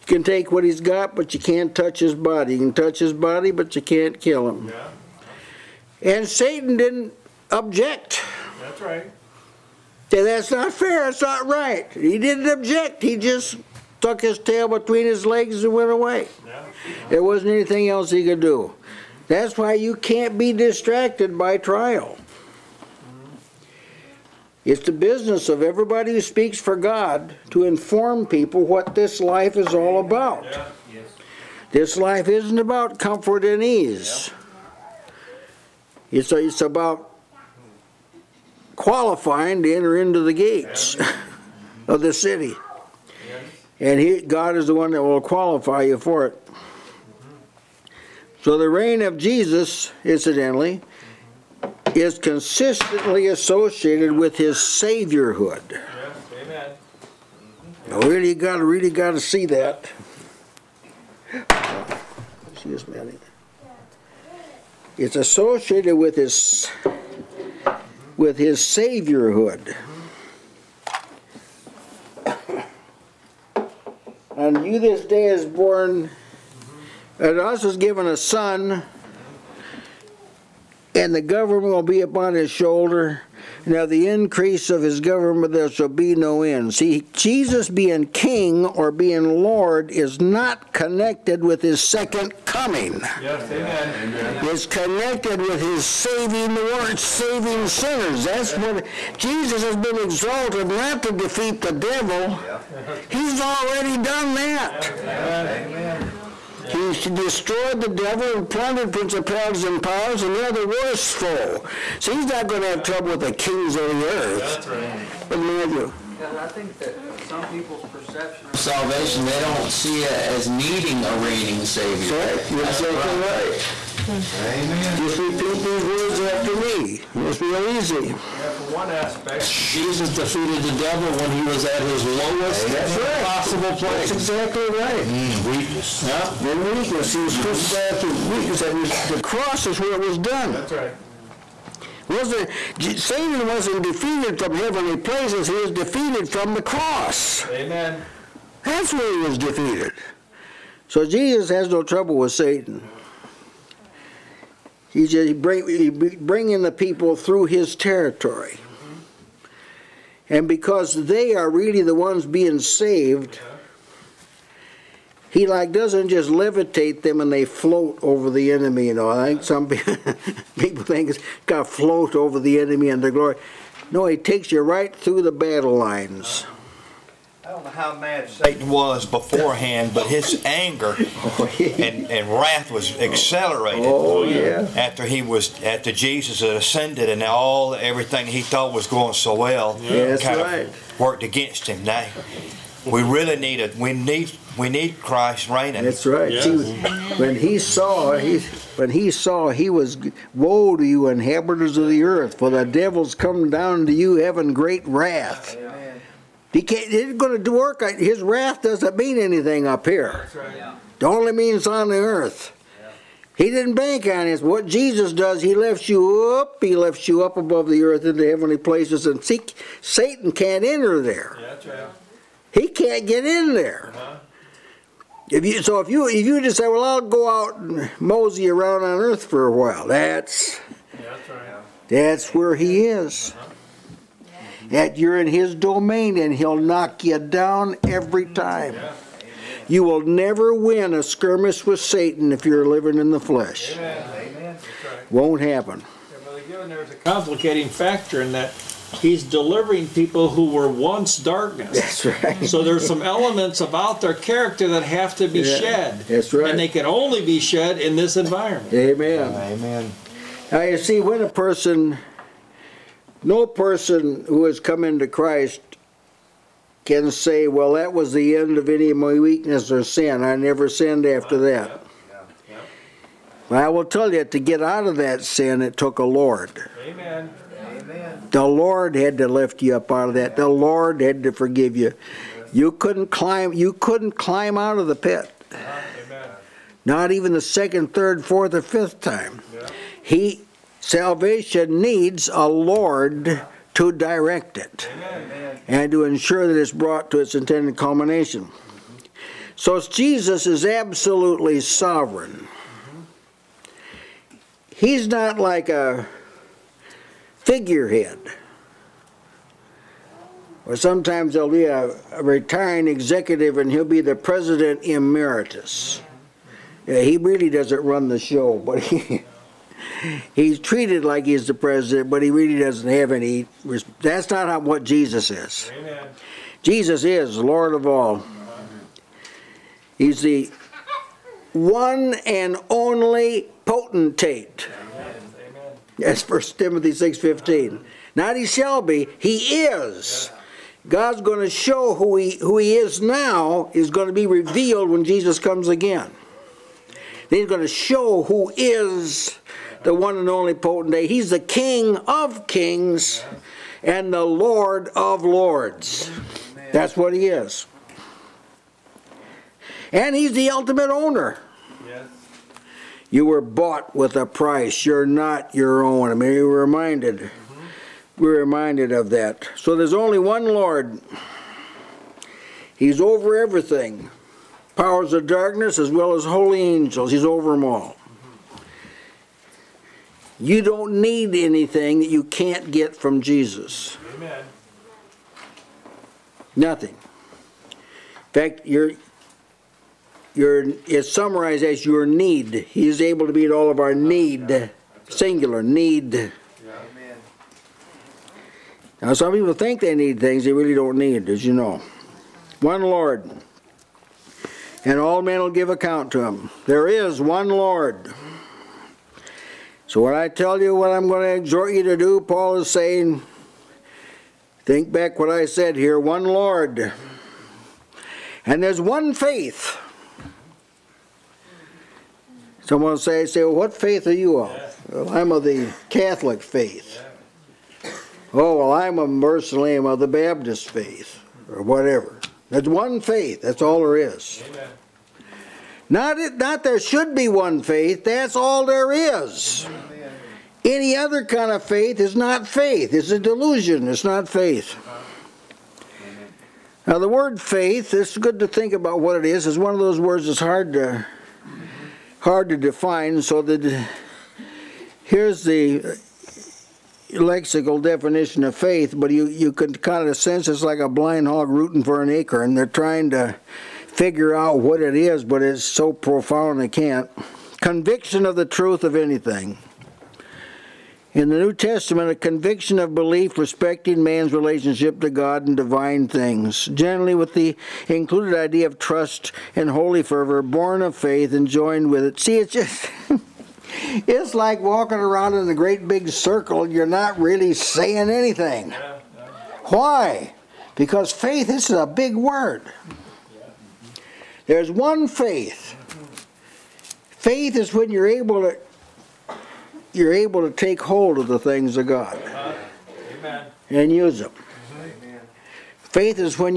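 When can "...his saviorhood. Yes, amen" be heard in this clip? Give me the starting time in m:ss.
0:54.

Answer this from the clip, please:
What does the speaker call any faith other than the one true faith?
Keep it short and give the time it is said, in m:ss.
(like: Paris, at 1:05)
A delusion, at 7:23.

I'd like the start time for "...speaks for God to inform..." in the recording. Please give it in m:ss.
0:26.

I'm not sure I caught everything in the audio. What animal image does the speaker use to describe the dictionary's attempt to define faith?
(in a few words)
A blind hog.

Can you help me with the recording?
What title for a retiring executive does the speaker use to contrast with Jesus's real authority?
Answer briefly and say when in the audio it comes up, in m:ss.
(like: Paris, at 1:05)
President emeritus, at 5:14.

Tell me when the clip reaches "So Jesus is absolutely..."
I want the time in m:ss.
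4:59.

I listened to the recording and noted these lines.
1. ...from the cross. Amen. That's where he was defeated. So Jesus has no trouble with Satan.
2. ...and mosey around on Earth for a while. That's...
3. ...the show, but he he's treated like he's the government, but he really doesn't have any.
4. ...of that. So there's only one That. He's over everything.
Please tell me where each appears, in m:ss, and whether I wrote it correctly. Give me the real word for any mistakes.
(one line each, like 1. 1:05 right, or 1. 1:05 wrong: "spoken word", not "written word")
1. 2:26 right
2. 3:47 right
3. 5:18 wrong: "president", not "government"
4. 6:08 wrong: "Lord", not "That".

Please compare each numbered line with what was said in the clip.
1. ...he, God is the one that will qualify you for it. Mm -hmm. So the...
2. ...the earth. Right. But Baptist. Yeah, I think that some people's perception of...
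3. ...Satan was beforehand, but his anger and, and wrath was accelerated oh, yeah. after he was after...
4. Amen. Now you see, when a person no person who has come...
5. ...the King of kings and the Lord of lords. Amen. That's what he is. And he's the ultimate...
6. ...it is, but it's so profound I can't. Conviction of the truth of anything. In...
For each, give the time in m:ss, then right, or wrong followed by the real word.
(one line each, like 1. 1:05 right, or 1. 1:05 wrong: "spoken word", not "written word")
1. 0:43 right
2. 1:53 wrong: "Matthew", not "Baptist"
3. 2:58 right
4. 4:19 right
5. 5:51 right
6. 7:44 right.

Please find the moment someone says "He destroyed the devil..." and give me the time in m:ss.
1:46.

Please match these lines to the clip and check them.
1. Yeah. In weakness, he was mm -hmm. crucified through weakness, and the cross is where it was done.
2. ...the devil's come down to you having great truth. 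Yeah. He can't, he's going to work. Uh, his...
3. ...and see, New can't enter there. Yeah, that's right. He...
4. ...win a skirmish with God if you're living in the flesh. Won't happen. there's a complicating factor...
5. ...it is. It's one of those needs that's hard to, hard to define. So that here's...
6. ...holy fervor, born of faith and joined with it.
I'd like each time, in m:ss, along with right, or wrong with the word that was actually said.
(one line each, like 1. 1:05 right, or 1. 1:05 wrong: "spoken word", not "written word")
1. 2:16 right
2. 3:22 wrong: "wrath", not "truth"
3. 3:39 wrong: "Satan", not "New"
4. 4:00 wrong: "Satan", not "God"
5. 7:29 wrong: "words", not "needs"
6. 7:59 right.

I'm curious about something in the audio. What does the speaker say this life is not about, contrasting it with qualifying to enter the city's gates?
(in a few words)
Comfort and ease.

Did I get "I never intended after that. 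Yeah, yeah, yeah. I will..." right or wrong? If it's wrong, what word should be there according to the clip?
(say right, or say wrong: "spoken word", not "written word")
wrong: "sinned", not "intended".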